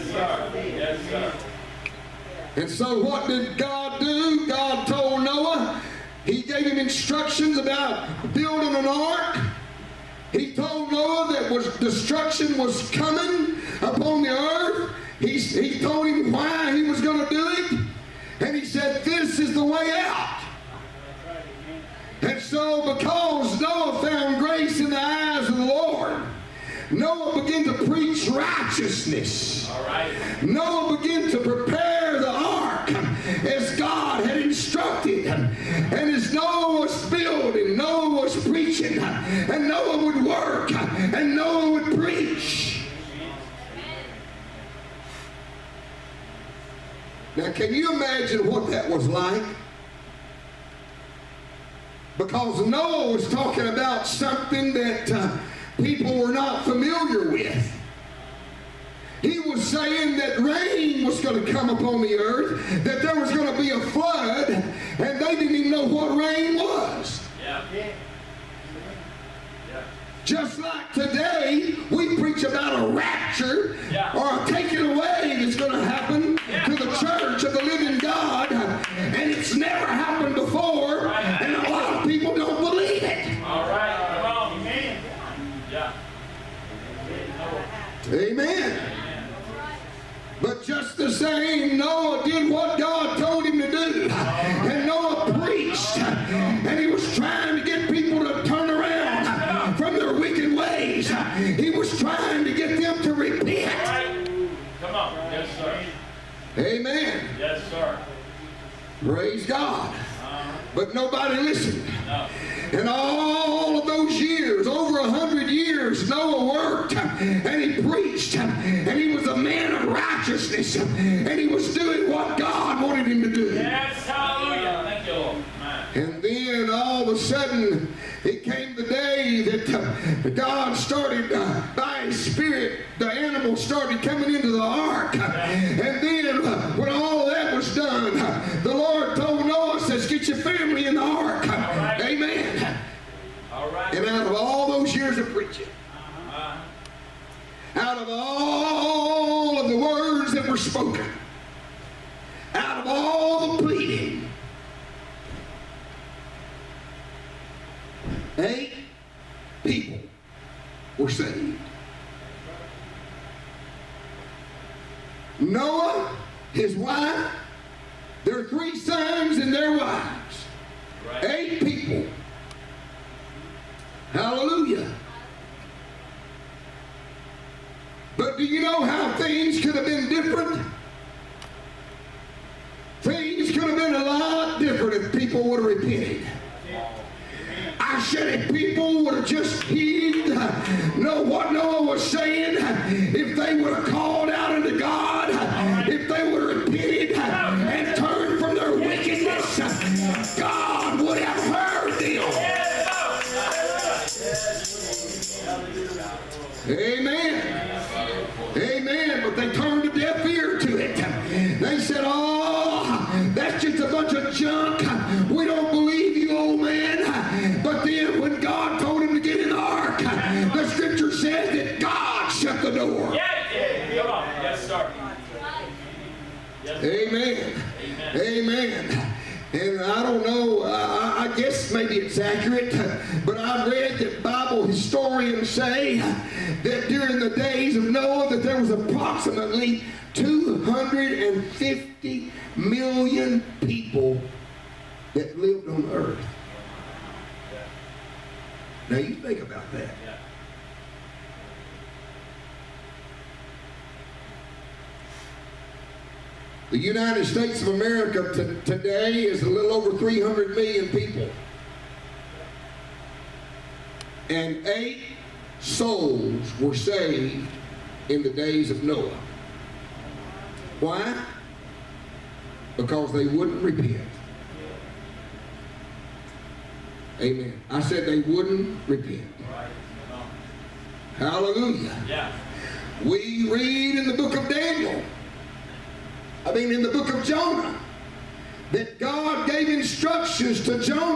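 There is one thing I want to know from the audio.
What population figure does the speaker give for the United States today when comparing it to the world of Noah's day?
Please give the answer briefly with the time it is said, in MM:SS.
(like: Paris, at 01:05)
300 million, at 04:19.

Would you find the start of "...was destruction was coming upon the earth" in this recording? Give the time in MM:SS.
00:11.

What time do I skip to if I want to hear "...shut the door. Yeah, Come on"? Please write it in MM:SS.
03:42.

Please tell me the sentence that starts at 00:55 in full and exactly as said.
Uh, people were not familiar with.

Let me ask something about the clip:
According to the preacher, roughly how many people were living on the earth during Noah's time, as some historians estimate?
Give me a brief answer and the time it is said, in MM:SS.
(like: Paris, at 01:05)
250 million, at 04:00.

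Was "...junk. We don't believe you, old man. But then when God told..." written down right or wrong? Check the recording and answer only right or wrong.
right.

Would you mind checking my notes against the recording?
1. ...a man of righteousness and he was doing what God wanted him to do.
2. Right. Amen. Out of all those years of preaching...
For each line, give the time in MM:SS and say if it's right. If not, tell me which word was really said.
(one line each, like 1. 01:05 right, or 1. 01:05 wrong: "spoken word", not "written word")
1. 01:59 right
2. 02:23 right.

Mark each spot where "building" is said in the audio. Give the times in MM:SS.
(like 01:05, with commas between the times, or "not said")
00:08, 00:37.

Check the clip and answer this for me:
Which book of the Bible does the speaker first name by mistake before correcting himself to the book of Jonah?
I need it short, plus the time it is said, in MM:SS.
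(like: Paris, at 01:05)
Daniel, at 04:44.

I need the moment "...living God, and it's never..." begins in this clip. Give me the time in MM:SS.
01:17.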